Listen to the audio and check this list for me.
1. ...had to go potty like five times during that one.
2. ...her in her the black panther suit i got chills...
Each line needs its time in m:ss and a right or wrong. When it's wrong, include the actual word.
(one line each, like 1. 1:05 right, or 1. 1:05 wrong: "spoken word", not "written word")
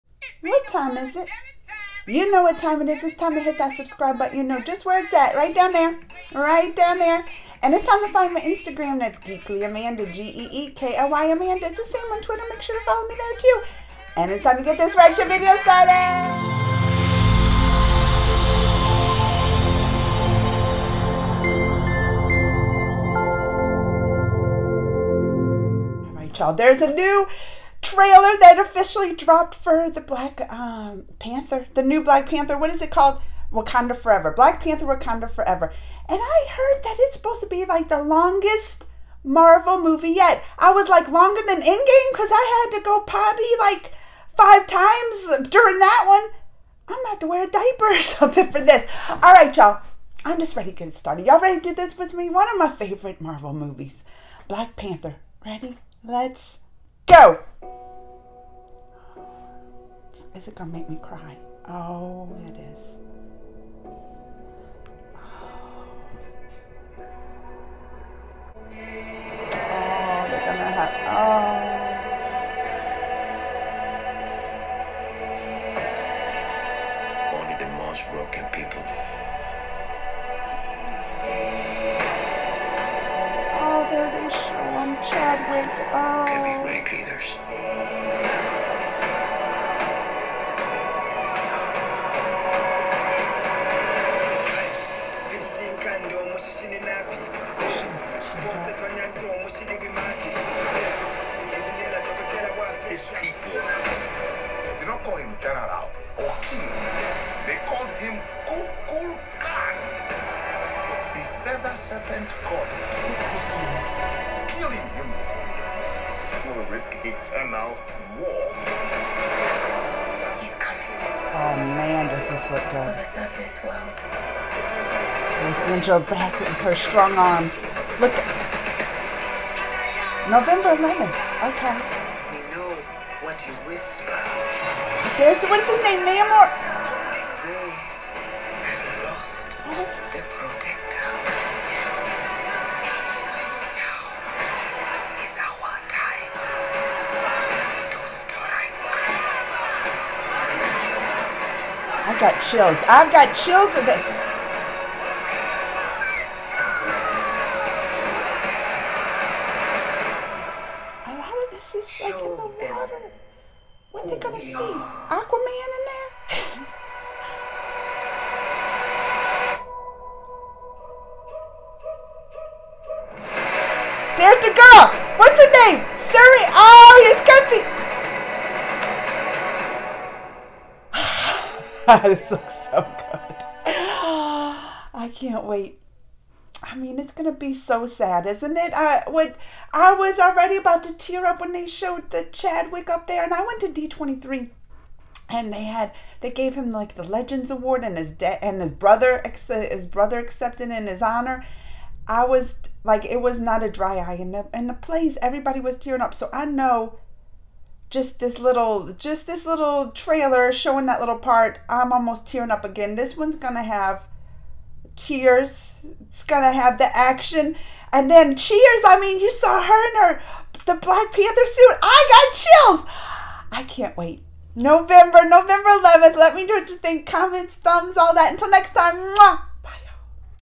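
1. 0:42 right
2. 3:39 right.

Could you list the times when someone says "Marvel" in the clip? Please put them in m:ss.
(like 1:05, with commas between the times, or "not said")
0:39, 0:53.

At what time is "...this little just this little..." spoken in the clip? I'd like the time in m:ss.
3:28.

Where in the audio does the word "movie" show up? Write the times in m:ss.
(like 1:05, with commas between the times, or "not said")
0:39, 0:53.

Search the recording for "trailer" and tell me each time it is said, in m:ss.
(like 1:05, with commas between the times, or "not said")
0:27, 3:29.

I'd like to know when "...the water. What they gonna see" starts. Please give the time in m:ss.
2:42.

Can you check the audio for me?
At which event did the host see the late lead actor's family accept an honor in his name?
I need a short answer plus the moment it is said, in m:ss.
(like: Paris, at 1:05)
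D23, at 3:13.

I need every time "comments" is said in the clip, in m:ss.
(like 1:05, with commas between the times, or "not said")
3:47.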